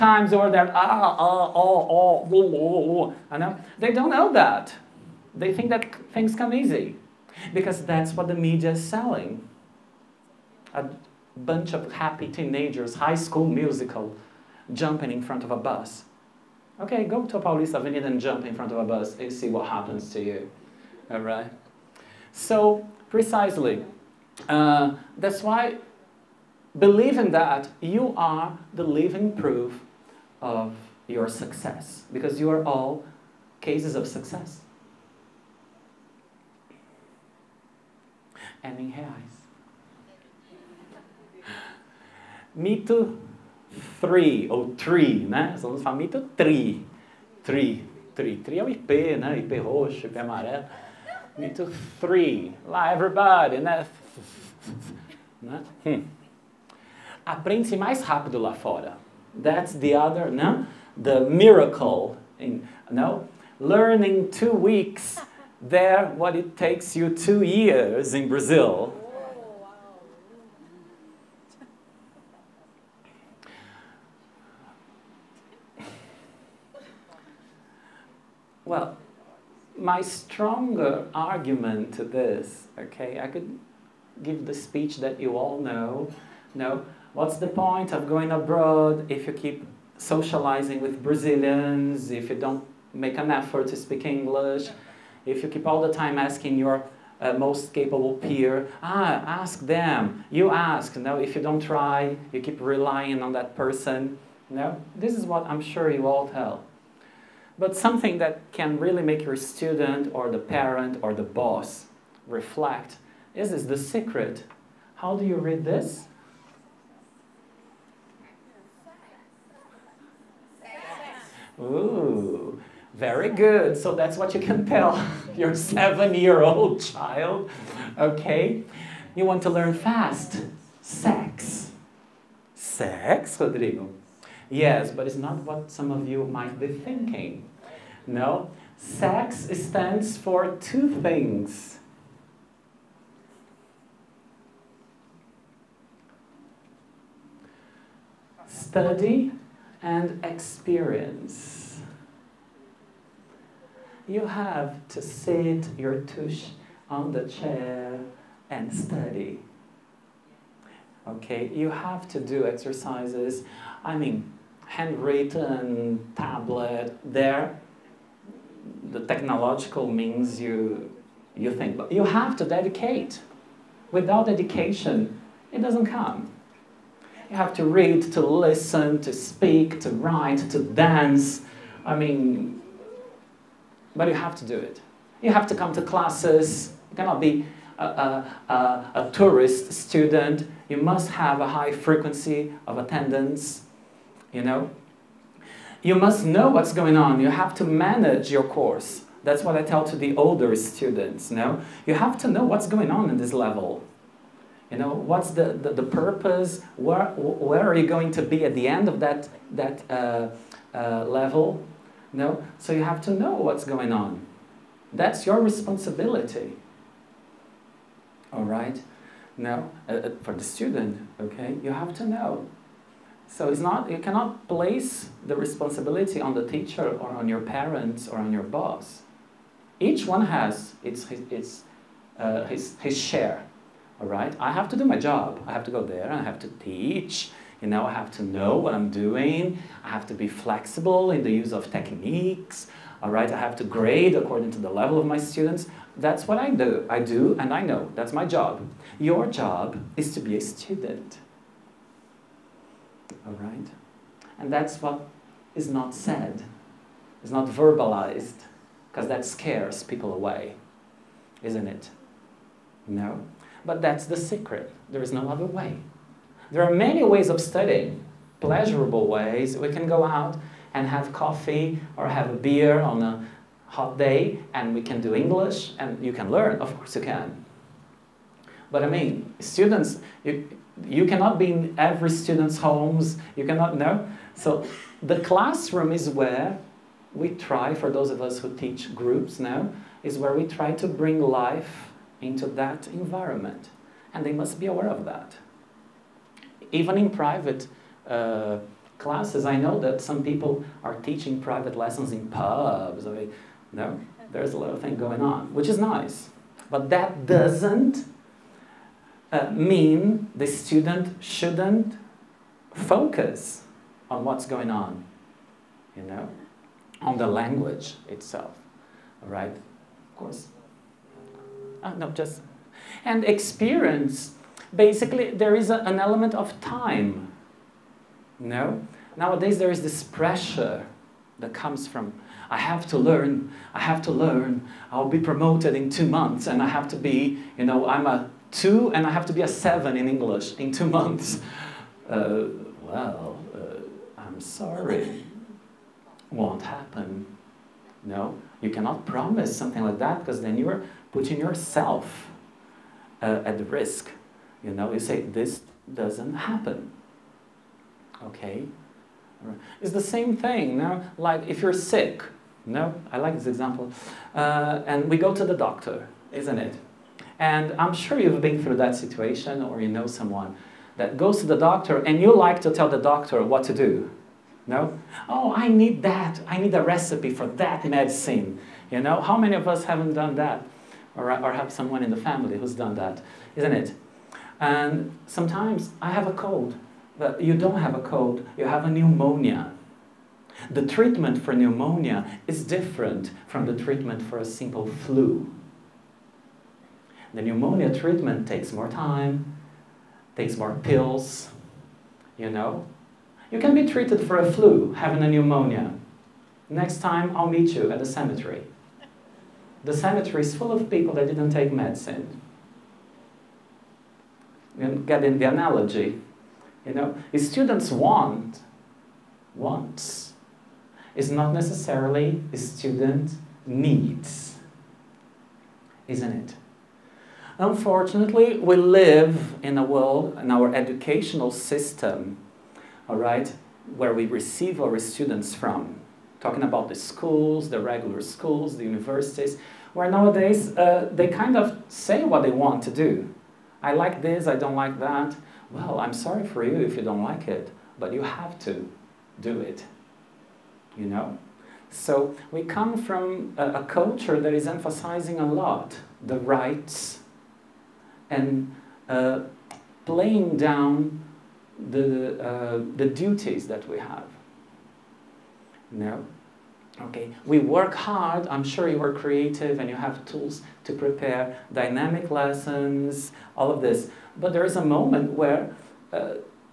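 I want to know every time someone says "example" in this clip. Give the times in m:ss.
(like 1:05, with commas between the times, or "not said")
6:03.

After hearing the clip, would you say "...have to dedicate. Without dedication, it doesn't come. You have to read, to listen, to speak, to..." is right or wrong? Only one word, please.
right.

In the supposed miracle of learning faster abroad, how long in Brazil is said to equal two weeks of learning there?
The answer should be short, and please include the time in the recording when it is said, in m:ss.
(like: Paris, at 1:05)
two years, at 1:07.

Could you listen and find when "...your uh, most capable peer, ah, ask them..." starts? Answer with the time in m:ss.
1:36.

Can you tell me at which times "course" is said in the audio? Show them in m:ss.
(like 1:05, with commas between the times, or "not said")
3:18, 4:36, 5:20.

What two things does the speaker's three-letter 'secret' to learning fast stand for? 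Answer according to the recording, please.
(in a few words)
Study and experience.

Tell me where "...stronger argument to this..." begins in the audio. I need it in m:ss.
1:20.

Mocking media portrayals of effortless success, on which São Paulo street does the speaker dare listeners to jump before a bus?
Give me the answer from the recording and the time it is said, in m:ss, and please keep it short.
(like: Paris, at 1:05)
Paulista Avenue, at 0:17.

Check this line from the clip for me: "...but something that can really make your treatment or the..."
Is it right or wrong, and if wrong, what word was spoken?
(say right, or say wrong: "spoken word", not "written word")
wrong: "student", not "treatment".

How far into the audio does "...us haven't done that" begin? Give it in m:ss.
6:19.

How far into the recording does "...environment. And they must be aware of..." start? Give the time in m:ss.
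4:52.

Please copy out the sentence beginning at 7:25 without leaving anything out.
Well, I'm sorry for you if you don't like it, but you have to do it.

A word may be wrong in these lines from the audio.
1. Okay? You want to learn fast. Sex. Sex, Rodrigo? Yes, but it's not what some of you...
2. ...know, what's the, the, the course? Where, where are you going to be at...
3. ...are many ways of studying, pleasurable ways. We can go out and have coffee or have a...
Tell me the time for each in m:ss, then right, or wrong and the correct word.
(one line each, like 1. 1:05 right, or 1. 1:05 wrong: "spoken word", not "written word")
1. 2:07 right
2. 3:24 wrong: "purpose", not "course"
3. 4:26 right.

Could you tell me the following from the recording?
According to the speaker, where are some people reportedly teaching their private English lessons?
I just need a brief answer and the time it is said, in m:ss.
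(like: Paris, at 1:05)
in pubs, at 5:02.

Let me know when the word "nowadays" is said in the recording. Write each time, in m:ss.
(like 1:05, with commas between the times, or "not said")
5:29, 7:20.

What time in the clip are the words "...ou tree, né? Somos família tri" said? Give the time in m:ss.
0:44.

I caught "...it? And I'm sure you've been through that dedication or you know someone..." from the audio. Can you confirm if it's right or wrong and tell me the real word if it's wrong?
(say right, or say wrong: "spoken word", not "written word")
wrong: "situation", not "dedication".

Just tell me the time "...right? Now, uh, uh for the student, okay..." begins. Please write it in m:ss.
3:38.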